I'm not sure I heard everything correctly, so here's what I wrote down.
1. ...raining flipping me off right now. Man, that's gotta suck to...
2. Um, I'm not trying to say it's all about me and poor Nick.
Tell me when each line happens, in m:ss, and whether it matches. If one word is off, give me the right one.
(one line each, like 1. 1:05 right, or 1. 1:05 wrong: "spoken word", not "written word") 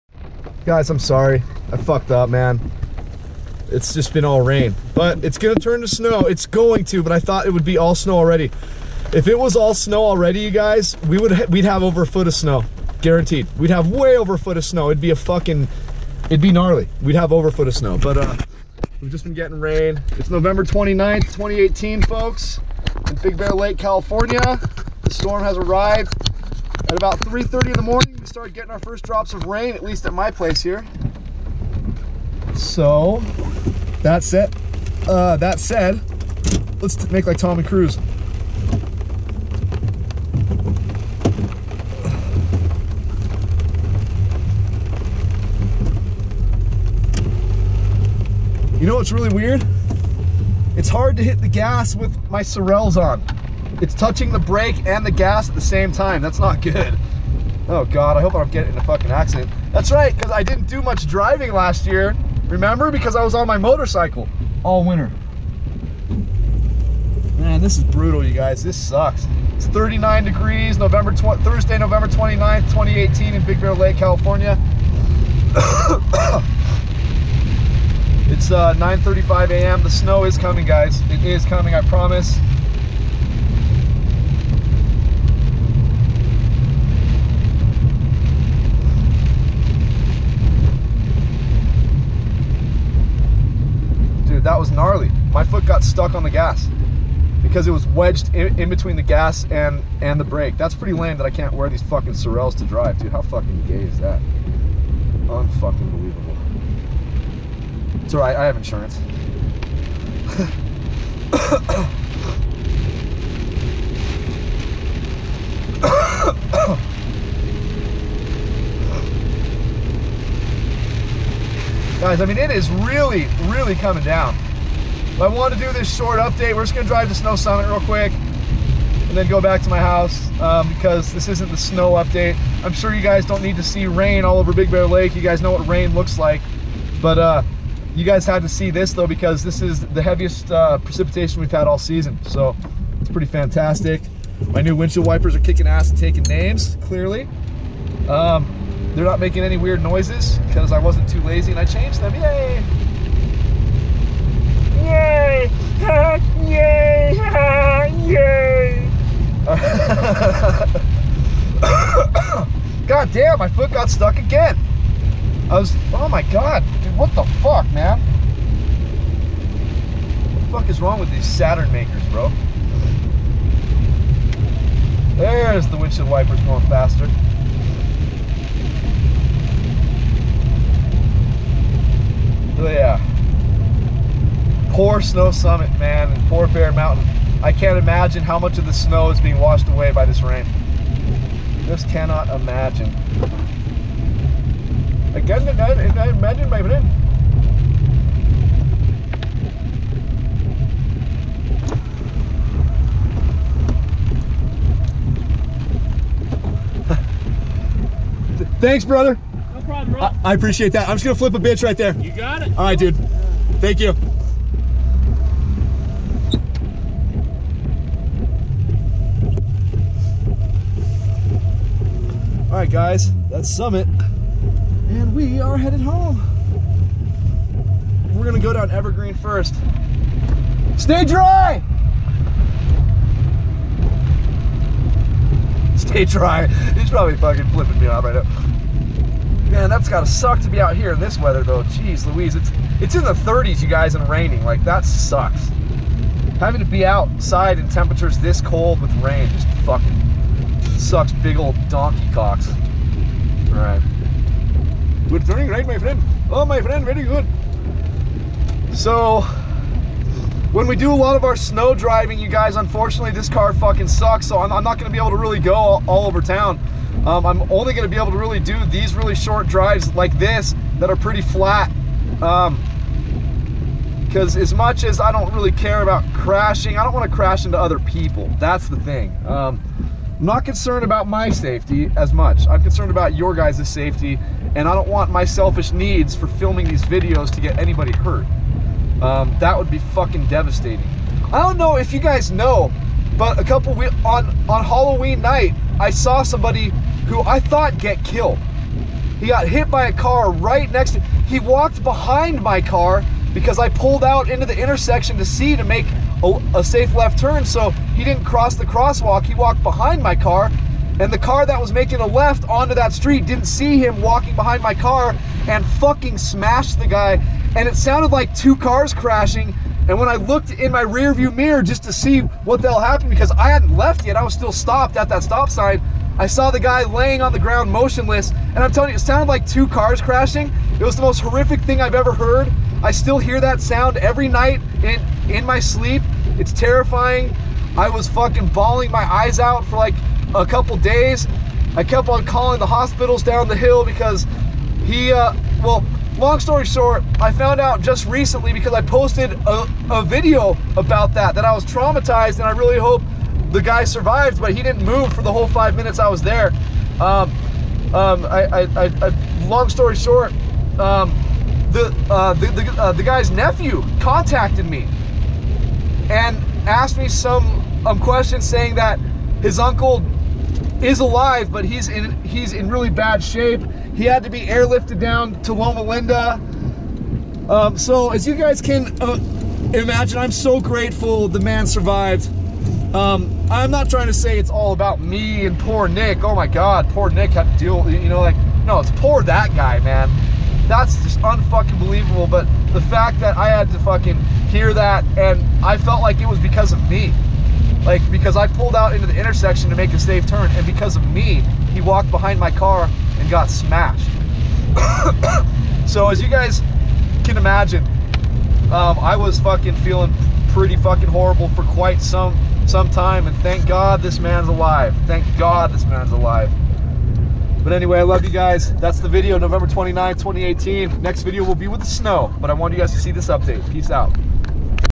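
1. 3:57 wrong: "fucking", not "raining"
2. 6:22 right.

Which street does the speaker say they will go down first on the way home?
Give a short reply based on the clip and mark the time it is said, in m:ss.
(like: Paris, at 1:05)
Evergreen, at 3:48.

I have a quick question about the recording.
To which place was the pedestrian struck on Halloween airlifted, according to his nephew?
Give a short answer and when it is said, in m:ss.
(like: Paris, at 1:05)
Loma Linda, at 6:15.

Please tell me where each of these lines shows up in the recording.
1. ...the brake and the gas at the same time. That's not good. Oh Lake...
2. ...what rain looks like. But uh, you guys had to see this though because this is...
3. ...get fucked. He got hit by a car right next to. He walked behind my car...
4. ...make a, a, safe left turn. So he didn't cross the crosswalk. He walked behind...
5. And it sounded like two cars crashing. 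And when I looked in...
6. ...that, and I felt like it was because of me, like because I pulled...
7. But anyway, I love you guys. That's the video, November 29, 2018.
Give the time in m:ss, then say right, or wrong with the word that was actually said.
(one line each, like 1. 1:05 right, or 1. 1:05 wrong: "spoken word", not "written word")
1. 0:54 wrong: "God", not "Lake"
2. 2:15 right
3. 4:57 wrong: "killed", not "fucked"
4. 5:05 right
5. 5:17 right
6. 6:34 right
7. 6:57 right.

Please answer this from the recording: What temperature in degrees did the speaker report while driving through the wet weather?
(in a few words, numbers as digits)
39.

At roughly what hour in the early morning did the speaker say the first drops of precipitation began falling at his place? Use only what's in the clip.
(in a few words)
3:30.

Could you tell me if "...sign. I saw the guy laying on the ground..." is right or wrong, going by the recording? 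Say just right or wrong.
right.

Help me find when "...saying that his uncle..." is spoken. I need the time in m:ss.
6:08.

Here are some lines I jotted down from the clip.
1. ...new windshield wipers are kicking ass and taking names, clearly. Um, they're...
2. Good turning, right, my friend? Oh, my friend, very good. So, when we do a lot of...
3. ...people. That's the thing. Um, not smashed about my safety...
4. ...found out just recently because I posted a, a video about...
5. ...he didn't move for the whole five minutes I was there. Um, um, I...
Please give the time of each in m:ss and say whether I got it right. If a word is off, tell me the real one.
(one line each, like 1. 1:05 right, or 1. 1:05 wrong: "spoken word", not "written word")
1. 2:24 right
2. 4:15 right
3. 4:37 wrong: "concerned", not "smashed"
4. 5:47 right
5. 5:54 right.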